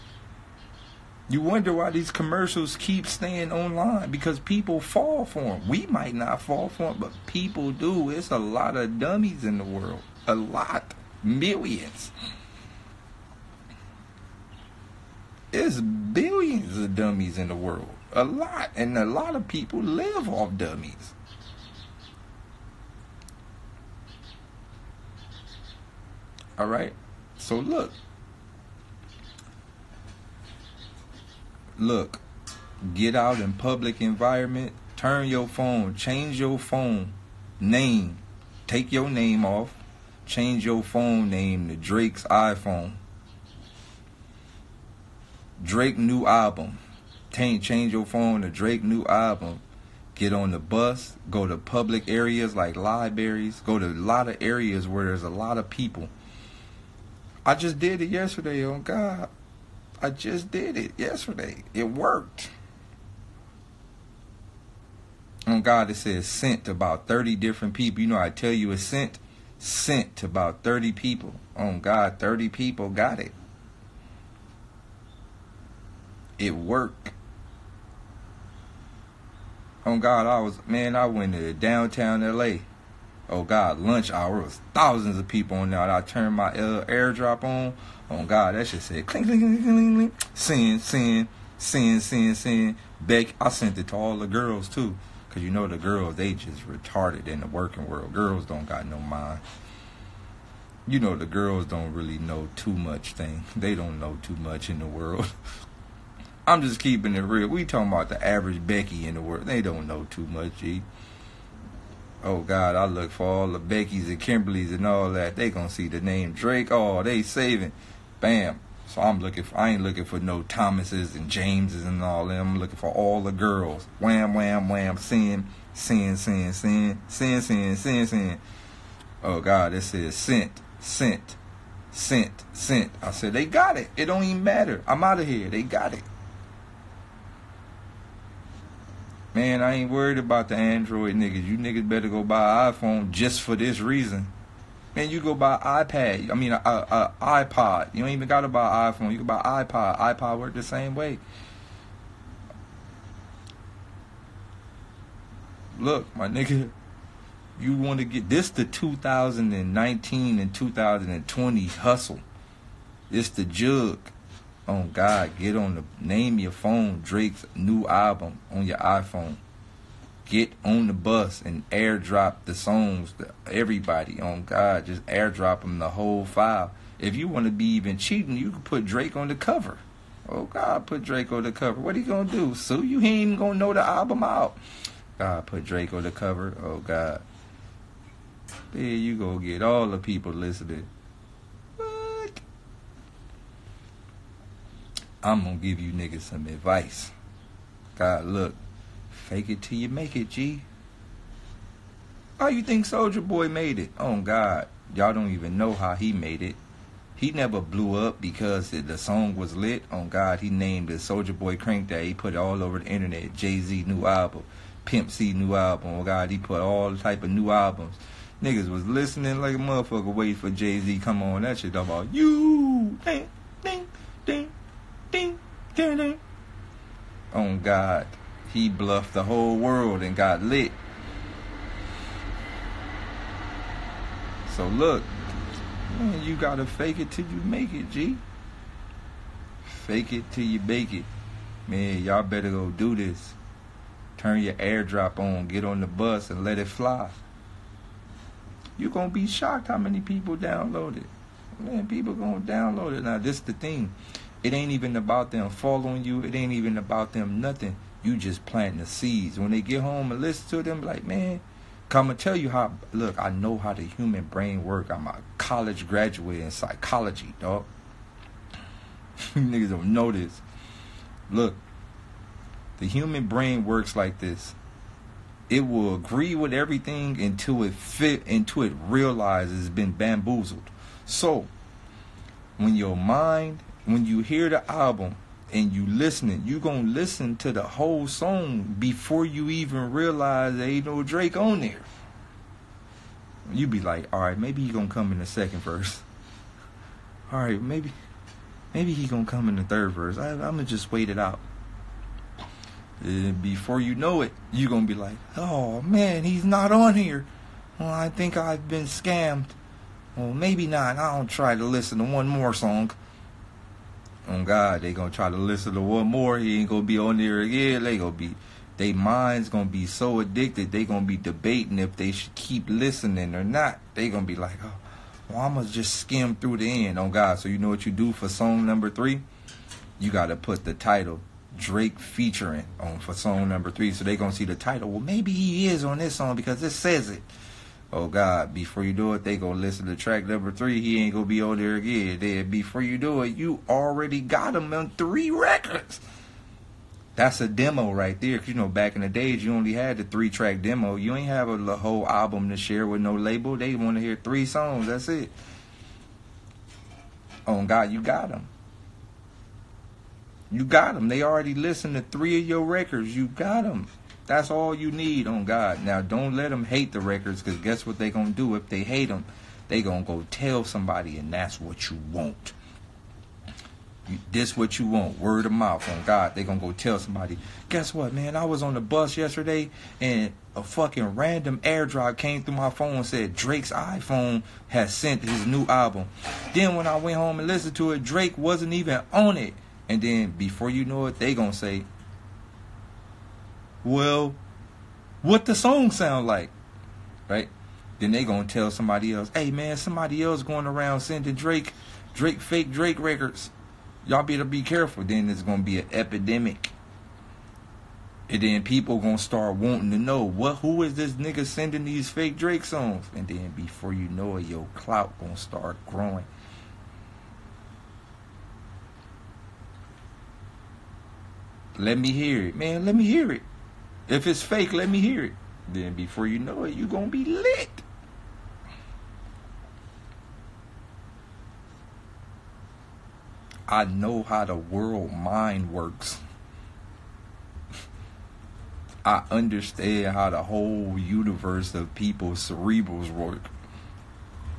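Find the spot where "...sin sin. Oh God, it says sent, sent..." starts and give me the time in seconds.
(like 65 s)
127 s.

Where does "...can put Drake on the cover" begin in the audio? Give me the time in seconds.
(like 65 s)
178 s.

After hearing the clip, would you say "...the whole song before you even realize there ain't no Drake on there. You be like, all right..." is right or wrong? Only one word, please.
right.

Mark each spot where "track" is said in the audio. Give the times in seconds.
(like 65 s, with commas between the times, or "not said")
339 s, 350 s.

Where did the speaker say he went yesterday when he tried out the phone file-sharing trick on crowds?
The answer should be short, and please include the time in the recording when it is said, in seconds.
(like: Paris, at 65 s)
Downtown LA, at 81 s.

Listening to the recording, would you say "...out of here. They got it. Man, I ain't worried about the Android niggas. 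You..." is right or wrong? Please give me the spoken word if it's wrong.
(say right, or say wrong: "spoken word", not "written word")
right.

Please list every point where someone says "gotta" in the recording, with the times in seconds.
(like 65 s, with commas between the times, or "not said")
148 s, 236 s, 330 s.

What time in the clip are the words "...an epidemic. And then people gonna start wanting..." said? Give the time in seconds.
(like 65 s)
405 s.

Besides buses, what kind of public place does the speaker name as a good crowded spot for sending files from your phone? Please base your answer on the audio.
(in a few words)
Libraries.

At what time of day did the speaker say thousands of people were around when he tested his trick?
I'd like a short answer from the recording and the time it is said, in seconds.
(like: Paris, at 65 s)
Lunch hour, at 83 s.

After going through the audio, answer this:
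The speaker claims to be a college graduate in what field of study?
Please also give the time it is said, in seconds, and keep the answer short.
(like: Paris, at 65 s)
Psychology, at 266 s.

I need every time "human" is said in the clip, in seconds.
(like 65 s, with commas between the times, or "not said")
263 s, 272 s.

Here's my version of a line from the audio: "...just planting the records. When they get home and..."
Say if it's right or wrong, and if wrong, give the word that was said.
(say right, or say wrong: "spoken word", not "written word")
wrong: "seeds", not "records".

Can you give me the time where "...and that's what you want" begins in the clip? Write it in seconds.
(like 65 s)
371 s.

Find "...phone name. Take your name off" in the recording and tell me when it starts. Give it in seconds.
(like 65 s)
36 s.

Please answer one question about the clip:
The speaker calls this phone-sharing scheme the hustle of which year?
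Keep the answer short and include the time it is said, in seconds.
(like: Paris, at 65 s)
2019, at 158 s.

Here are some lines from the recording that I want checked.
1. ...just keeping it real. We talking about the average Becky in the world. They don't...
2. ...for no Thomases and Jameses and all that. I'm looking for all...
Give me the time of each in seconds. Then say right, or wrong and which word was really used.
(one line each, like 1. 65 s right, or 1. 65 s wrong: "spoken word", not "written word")
1. 106 s right
2. 120 s right.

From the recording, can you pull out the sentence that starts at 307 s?
Well, I think I've been scammed.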